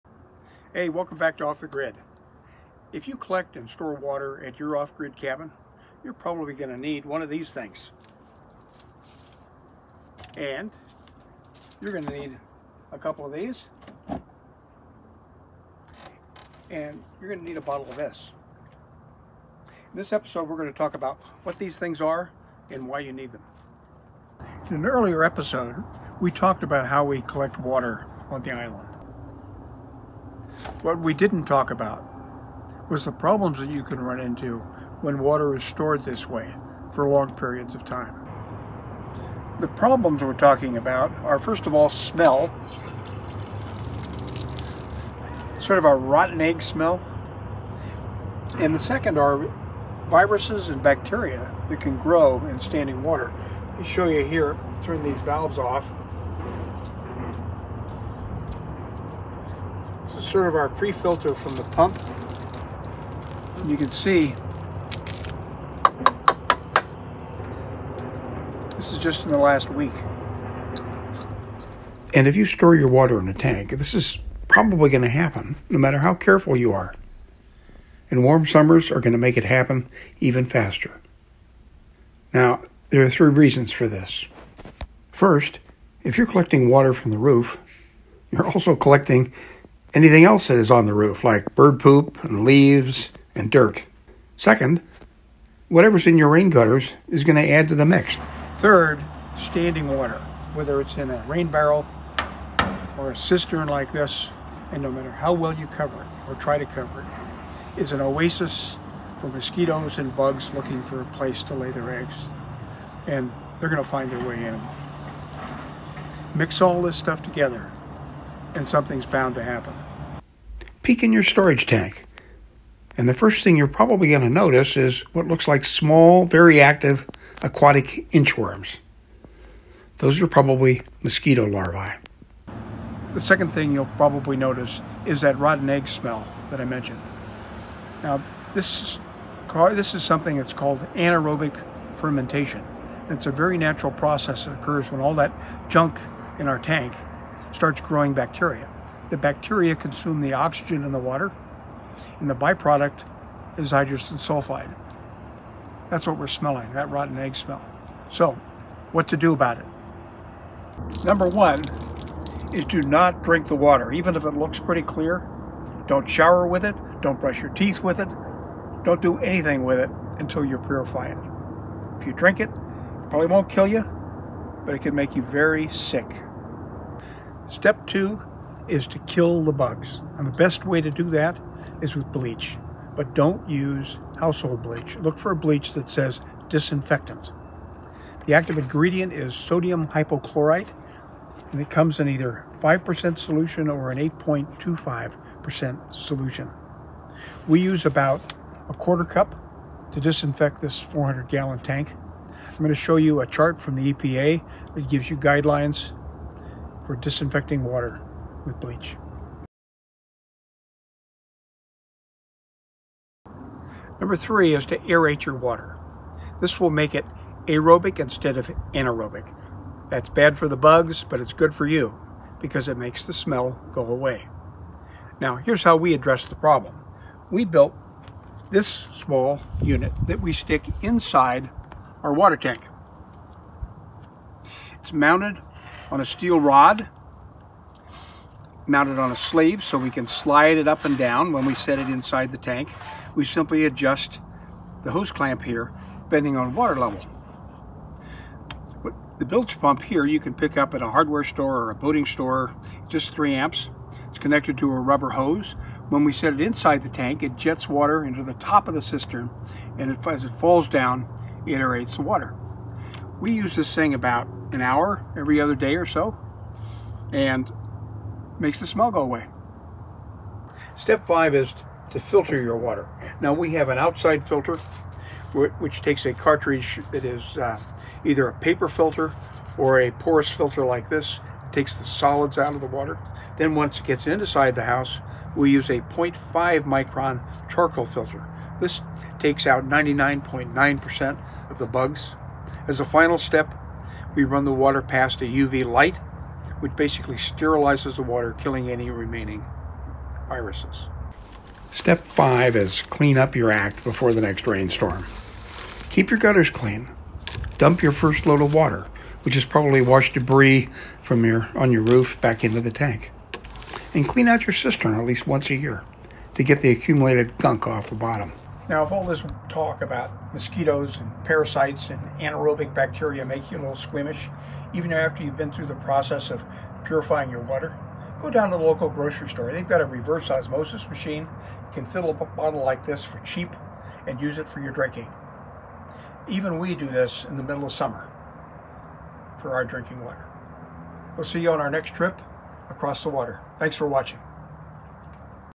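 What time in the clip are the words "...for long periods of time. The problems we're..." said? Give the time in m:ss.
0:36.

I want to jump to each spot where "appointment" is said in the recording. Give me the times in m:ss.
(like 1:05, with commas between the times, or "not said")
not said.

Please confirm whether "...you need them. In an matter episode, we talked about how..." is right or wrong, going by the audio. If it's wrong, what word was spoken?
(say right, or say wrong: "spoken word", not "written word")
wrong: "earlier", not "matter".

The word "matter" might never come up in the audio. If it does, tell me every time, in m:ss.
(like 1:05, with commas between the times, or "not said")
1:15, 1:44.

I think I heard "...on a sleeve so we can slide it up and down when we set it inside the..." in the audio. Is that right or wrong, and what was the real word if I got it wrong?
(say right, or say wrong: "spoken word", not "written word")
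right.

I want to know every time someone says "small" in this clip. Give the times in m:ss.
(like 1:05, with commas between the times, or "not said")
2:05, 3:48.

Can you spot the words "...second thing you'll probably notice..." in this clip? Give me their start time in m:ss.
2:13.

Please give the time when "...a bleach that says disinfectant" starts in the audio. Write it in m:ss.
3:05.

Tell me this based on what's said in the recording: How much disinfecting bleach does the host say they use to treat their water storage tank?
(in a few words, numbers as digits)
a quarter cup.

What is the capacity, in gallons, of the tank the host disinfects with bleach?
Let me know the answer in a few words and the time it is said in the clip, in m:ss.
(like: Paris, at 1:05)
400 gallons, at 3:20.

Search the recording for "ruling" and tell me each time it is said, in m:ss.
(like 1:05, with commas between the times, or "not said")
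not said.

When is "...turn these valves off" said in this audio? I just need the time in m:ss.
0:54.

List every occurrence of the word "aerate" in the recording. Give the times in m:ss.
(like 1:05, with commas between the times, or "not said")
3:34, 4:21.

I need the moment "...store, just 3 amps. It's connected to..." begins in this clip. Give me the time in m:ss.
4:12.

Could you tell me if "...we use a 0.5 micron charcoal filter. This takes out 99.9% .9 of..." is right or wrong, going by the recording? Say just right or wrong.
right.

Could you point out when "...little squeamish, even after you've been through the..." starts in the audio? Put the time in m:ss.
5:23.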